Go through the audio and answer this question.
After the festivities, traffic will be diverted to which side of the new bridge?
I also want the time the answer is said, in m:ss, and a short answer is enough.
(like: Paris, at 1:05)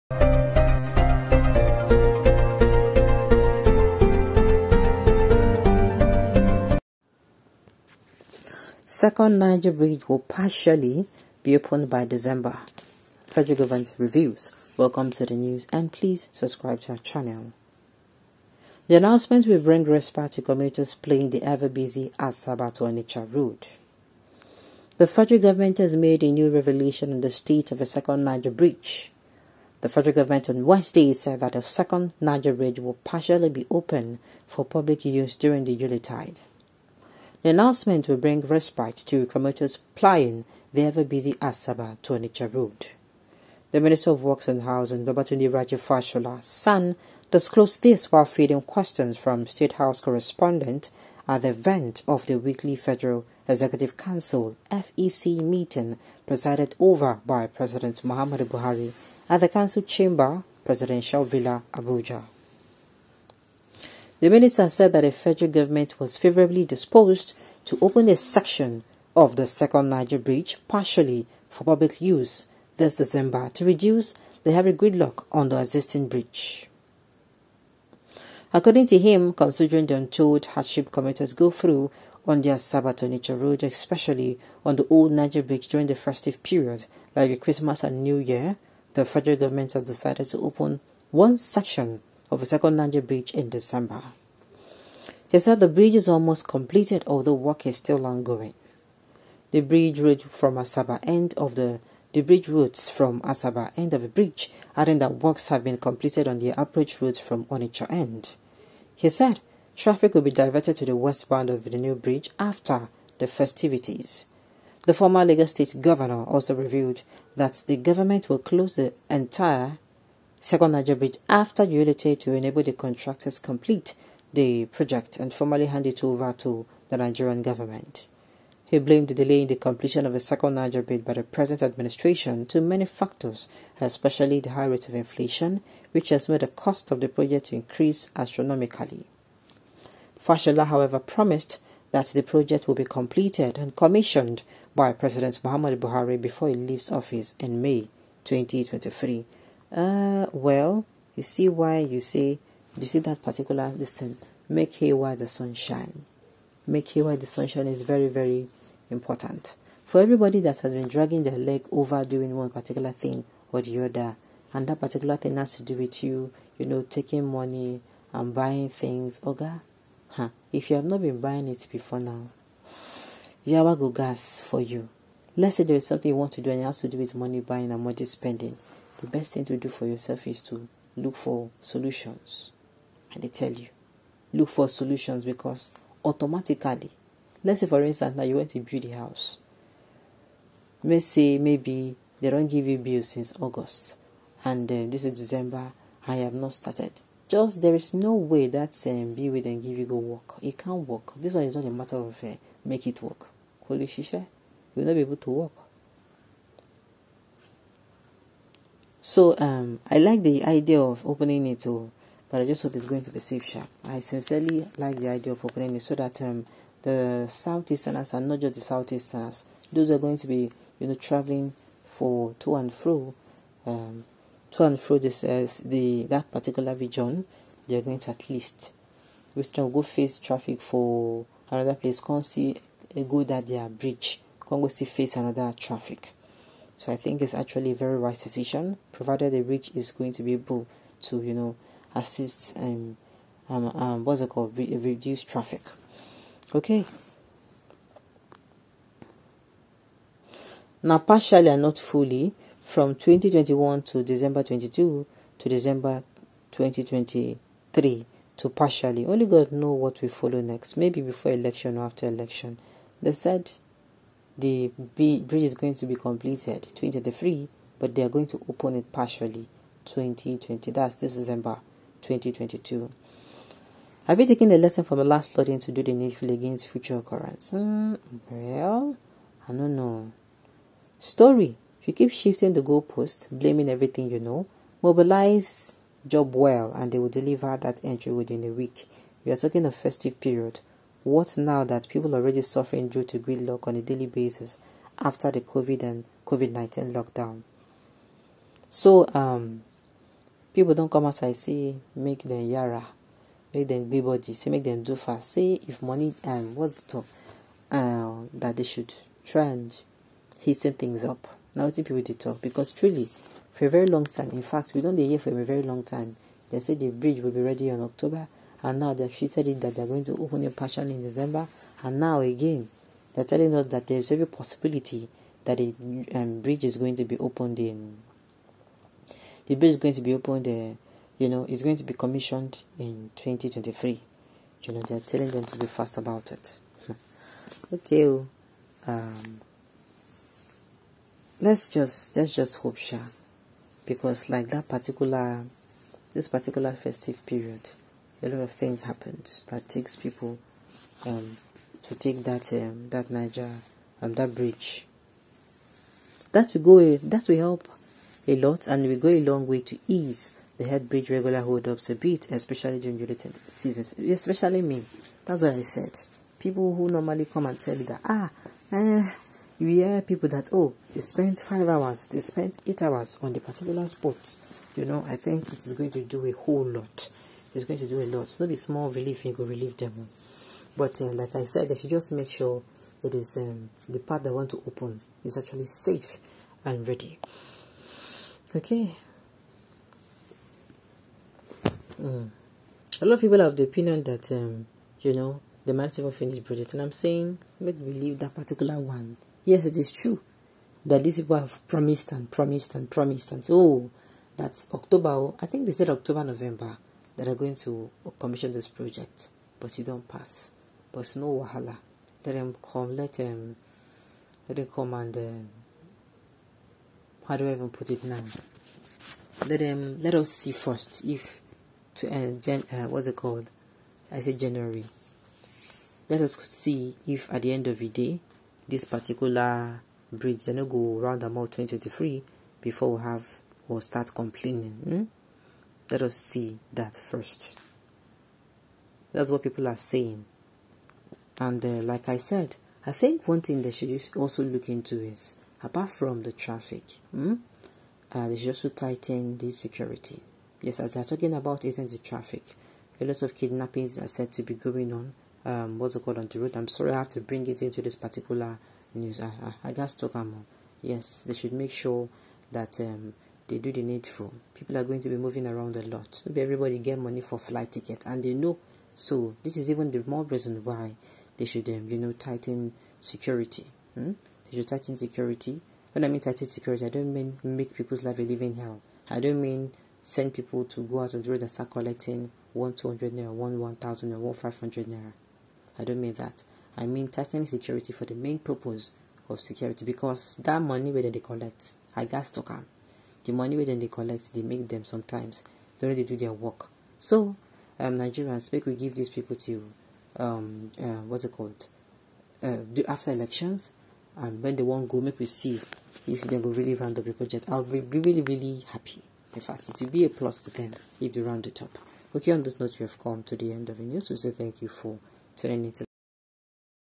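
westbound, at 1:50.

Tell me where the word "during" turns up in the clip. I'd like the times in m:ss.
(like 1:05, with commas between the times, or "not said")
0:35, 1:25, 6:02, 8:15.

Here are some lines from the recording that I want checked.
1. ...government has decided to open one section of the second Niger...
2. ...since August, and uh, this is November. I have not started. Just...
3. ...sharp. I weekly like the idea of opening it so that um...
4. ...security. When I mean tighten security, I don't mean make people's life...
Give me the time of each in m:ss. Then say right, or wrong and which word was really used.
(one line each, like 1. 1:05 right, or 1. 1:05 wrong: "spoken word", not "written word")
1. 1:29 right
2. 3:13 wrong: "December", not "November"
3. 3:33 wrong: "sincerely", not "weekly"
4. 7:54 right.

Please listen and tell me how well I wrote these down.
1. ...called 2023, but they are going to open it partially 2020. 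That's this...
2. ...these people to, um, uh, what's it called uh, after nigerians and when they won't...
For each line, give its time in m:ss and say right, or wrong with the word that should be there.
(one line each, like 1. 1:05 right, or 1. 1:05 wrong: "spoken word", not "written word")
1. 4:25 wrong: "completed", not "called"
2. 8:18 wrong: "elections", not "nigerians".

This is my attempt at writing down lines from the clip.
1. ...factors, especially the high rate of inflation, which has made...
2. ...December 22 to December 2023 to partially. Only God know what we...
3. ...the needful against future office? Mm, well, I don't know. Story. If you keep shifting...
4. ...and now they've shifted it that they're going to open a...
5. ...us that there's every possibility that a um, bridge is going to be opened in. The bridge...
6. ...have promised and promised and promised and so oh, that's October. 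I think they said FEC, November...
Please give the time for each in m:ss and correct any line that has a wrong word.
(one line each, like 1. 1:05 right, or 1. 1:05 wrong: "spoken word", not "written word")
1. 2:12 right
2. 4:14 right
3. 4:35 wrong: "occurrence", not "office"
4. 5:18 right
5. 5:23 right
6. 6:41 wrong: "October", not "FEC".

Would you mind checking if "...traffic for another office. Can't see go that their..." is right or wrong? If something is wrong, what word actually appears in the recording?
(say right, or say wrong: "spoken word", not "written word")
wrong: "place", not "office".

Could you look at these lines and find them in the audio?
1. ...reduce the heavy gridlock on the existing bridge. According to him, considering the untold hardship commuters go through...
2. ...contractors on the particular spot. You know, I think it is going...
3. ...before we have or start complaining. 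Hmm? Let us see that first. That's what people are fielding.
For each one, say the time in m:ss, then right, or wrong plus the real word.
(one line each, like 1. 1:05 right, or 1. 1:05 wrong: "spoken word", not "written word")
1. 1:13 right
2. 6:12 wrong: "hours", not "contractors"
3. 7:12 wrong: "saying", not "fielding".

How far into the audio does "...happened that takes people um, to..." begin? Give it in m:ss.
5:48.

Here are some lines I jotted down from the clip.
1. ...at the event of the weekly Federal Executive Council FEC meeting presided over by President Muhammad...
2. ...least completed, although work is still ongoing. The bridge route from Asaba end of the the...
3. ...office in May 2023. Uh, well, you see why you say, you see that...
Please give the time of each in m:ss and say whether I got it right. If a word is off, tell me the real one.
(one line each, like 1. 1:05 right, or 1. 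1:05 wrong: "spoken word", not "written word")
1. 0:51 right
2. 1:36 wrong: "almost", not "least"
3. 2:26 right.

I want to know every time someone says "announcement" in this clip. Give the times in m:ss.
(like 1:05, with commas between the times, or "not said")
0:18, 0:37.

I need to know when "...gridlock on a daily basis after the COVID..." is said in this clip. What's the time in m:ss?
4:53.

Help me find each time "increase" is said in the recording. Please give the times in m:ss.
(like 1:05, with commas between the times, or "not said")
2:17.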